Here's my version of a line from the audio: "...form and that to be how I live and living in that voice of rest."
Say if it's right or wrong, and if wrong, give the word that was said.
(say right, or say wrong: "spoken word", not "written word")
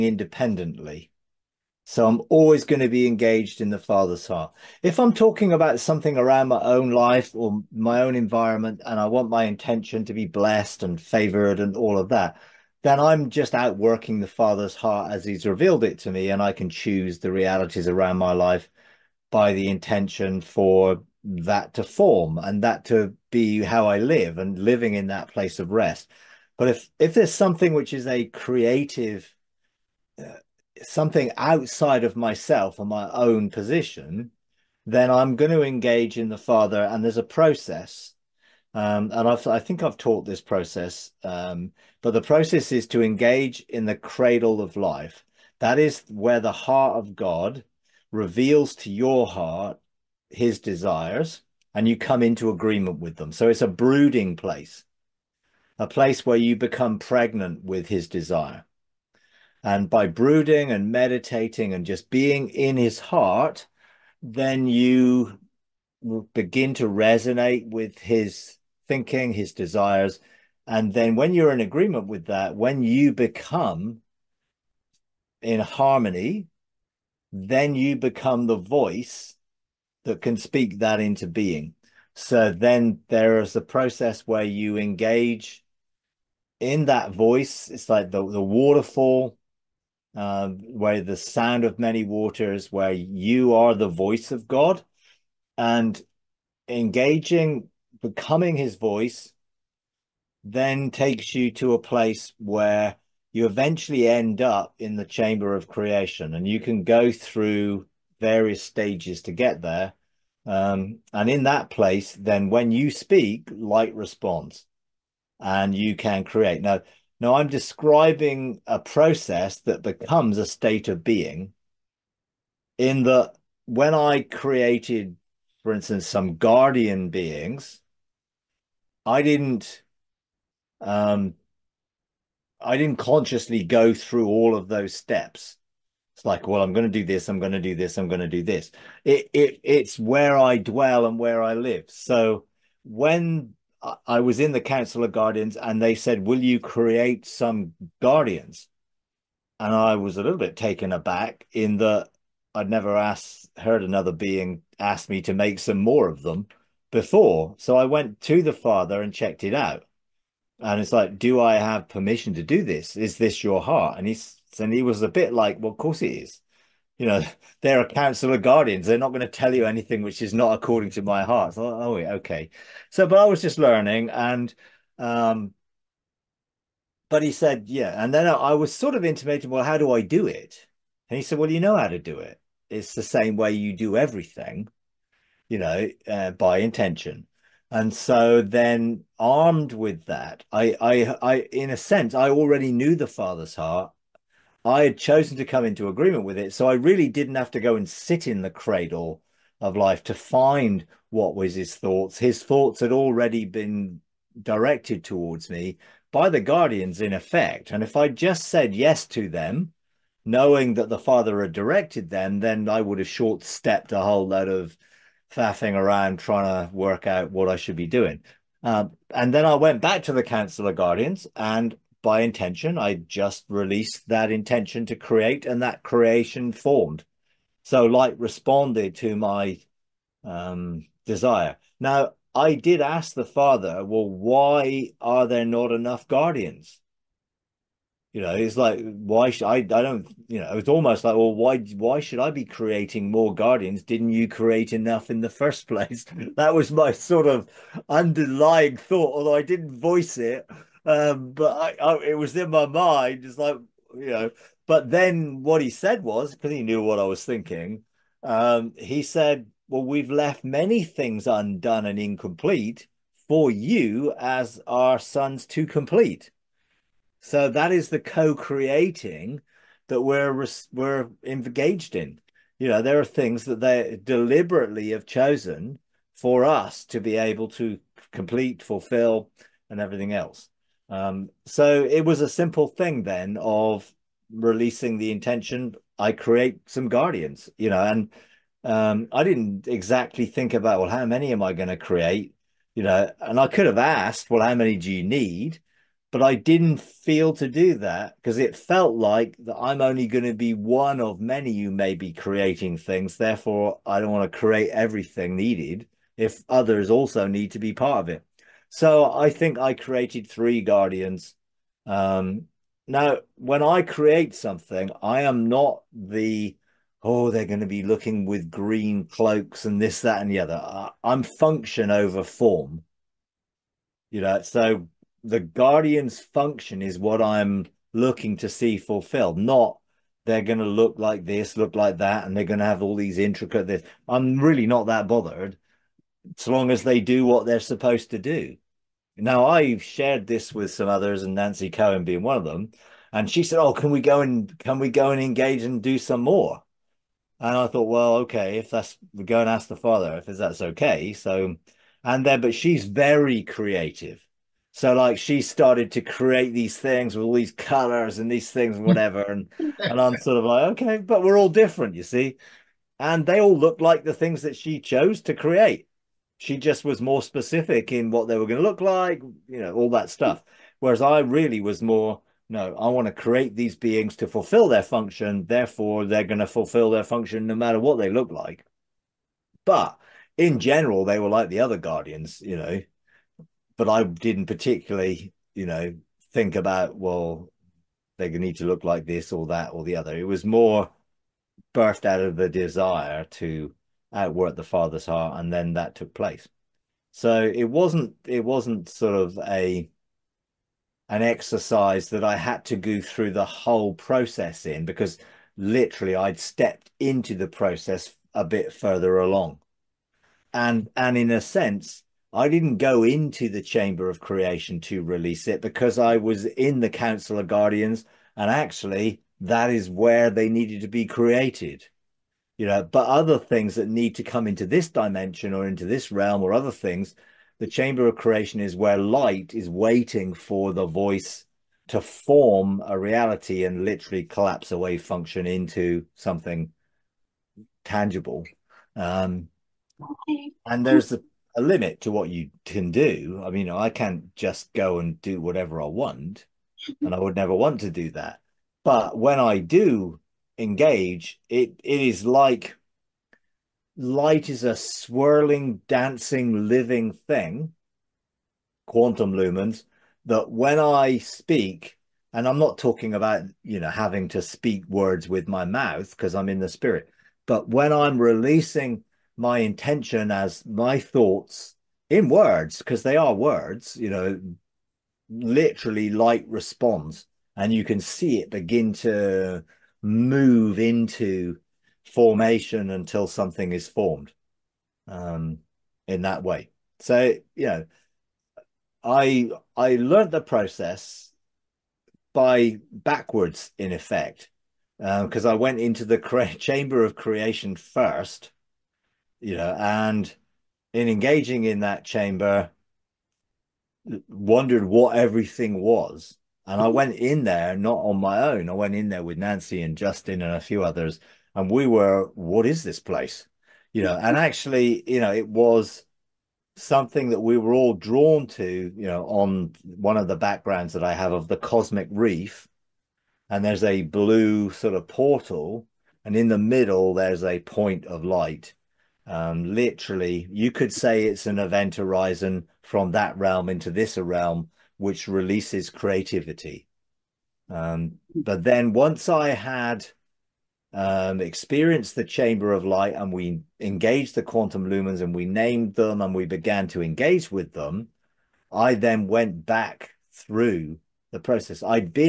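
wrong: "place", not "voice".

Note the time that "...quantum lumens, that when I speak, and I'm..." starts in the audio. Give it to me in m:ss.
7:38.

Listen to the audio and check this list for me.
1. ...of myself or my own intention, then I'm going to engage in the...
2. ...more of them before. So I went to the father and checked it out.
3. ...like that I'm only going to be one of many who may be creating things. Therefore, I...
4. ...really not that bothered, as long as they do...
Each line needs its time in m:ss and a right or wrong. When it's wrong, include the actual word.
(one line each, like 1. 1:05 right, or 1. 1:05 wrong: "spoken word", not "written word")
1. 0:32 wrong: "position", not "intention"
2. 2:35 right
3. 4:58 right
4. 5:34 right.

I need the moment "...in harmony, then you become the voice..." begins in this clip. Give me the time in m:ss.
1:15.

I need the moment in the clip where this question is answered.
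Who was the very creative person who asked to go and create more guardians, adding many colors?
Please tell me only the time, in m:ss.
5:41.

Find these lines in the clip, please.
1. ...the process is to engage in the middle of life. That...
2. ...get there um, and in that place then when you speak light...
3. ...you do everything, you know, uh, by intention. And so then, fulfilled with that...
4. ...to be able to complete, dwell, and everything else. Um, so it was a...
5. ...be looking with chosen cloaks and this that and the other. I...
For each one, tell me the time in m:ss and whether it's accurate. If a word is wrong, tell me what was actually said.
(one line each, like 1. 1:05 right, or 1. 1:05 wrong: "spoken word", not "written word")
1. 0:42 wrong: "cradle", not "middle"
2. 1:49 right
3. 3:03 wrong: "armed", not "fulfilled"
4. 4:36 wrong: "fulfill", not "dwell"
5. 5:17 wrong: "green", not "chosen".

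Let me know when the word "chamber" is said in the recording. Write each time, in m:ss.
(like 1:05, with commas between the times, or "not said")
1:45, 6:53, 7:07, 8:16, 8:22, 9:02.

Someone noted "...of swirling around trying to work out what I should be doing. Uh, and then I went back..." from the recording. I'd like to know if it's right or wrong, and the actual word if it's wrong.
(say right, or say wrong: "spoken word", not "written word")
wrong: "faffing", not "swirling".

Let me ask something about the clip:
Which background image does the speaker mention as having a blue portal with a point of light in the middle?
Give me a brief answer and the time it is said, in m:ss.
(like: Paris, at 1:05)
the cosmic reef, at 8:41.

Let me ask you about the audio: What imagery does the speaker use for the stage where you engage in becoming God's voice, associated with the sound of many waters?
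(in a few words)
the waterfall.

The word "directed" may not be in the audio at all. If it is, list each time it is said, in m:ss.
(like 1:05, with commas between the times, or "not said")
3:24, 3:31.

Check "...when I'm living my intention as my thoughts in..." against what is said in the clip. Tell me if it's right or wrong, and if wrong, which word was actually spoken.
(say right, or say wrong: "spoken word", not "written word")
wrong: "releasing", not "living".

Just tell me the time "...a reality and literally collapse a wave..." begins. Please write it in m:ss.
7:12.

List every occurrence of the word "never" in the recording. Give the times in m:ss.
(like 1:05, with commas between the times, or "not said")
2:32, 7:27.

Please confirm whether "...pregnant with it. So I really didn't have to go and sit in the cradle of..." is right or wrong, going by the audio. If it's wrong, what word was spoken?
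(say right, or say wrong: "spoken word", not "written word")
wrong: "agreement", not "pregnant".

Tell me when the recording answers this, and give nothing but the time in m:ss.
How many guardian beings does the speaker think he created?
5:10.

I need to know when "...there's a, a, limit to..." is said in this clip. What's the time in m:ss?
7:20.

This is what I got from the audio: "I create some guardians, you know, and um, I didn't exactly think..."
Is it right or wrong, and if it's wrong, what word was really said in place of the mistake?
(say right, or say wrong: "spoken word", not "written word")
right.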